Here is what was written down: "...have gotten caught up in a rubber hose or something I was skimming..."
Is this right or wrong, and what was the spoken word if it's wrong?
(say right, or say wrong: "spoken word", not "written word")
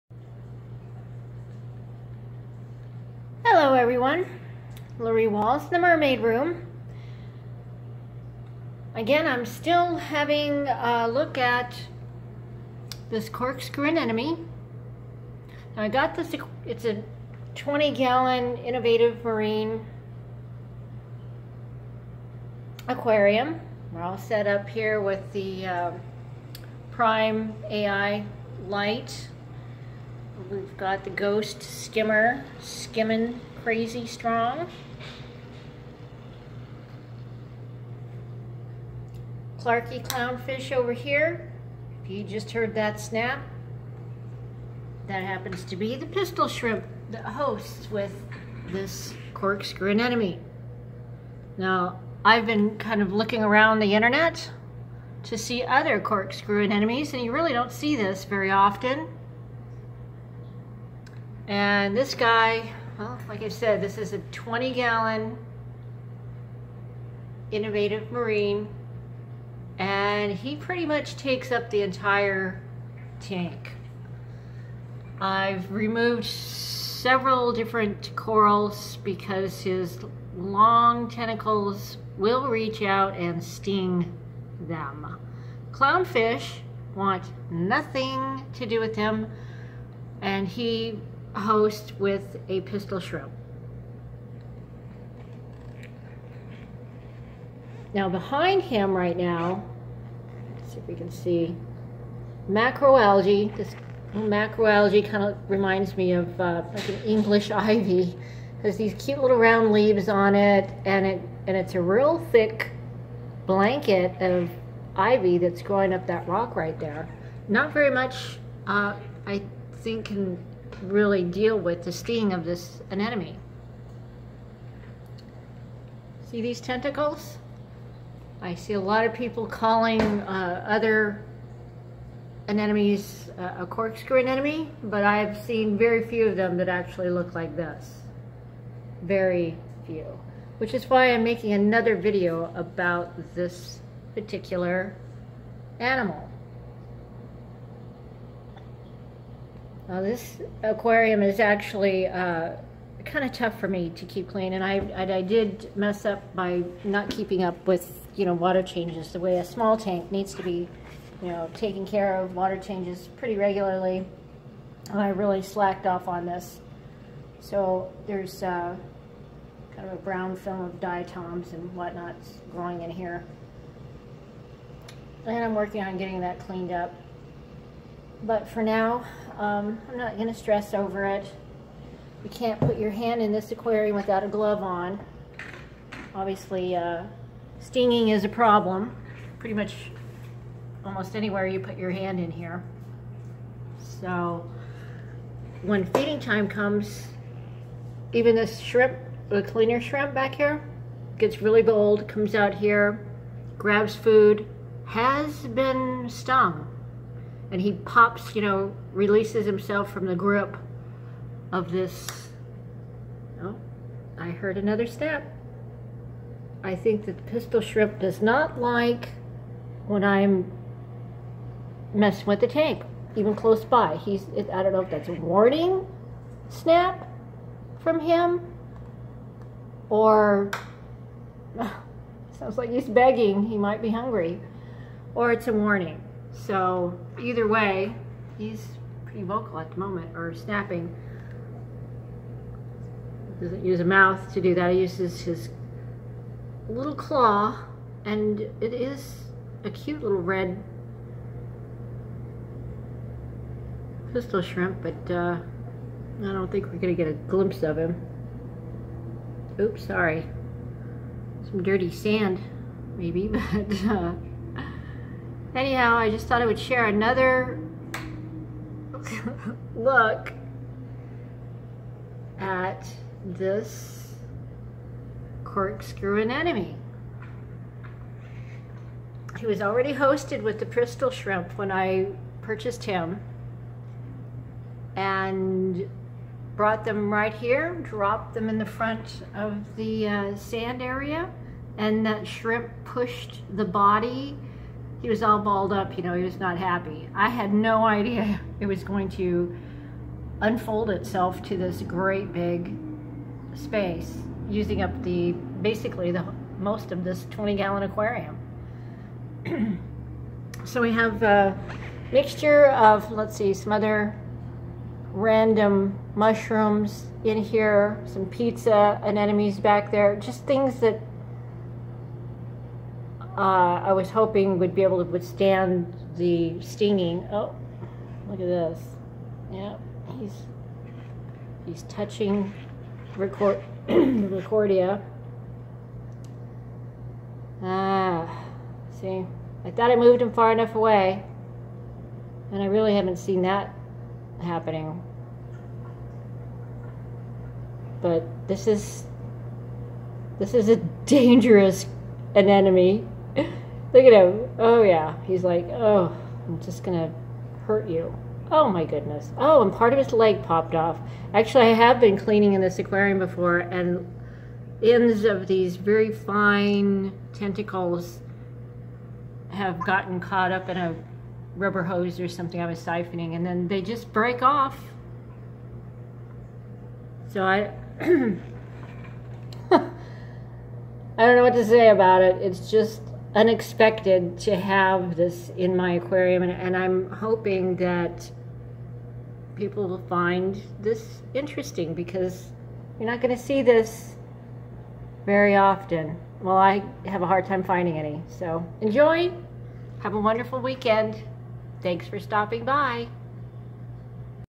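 wrong: "siphoning", not "skimming".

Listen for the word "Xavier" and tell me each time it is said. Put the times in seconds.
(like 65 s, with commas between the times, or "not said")
not said.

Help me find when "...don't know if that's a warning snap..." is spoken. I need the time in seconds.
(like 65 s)
224 s.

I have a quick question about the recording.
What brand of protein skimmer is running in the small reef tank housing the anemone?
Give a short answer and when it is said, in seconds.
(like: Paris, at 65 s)
Ghost, at 31 s.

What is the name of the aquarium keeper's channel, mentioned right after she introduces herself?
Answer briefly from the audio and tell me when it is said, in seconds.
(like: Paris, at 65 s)
The Mermaid Room, at 5 s.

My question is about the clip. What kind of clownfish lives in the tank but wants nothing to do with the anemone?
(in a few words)
Clarkii.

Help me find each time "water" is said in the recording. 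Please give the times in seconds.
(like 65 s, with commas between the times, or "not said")
158 s, 162 s.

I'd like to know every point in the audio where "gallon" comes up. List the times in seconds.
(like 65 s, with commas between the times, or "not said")
17 s, 64 s, 307 s.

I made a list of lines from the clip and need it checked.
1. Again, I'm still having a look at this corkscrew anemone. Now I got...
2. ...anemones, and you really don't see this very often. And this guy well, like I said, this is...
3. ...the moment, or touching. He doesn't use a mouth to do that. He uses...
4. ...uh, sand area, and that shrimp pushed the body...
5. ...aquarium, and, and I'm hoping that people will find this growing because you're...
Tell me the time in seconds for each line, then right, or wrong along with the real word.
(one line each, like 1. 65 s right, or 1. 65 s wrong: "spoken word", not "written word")
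1. 8 s right
2. 56 s right
3. 239 s wrong: "snapping", not "touching"
4. 290 s right
5. 385 s wrong: "interesting", not "growing".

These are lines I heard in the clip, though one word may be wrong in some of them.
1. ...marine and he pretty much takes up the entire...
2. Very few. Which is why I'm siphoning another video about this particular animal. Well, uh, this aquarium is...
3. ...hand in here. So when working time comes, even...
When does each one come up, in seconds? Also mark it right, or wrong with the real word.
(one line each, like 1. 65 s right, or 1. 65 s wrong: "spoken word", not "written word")
1. 68 s right
2. 139 s wrong: "making", not "siphoning"
3. 191 s wrong: "feeding", not "working".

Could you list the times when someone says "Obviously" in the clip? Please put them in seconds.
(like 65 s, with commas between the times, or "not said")
186 s.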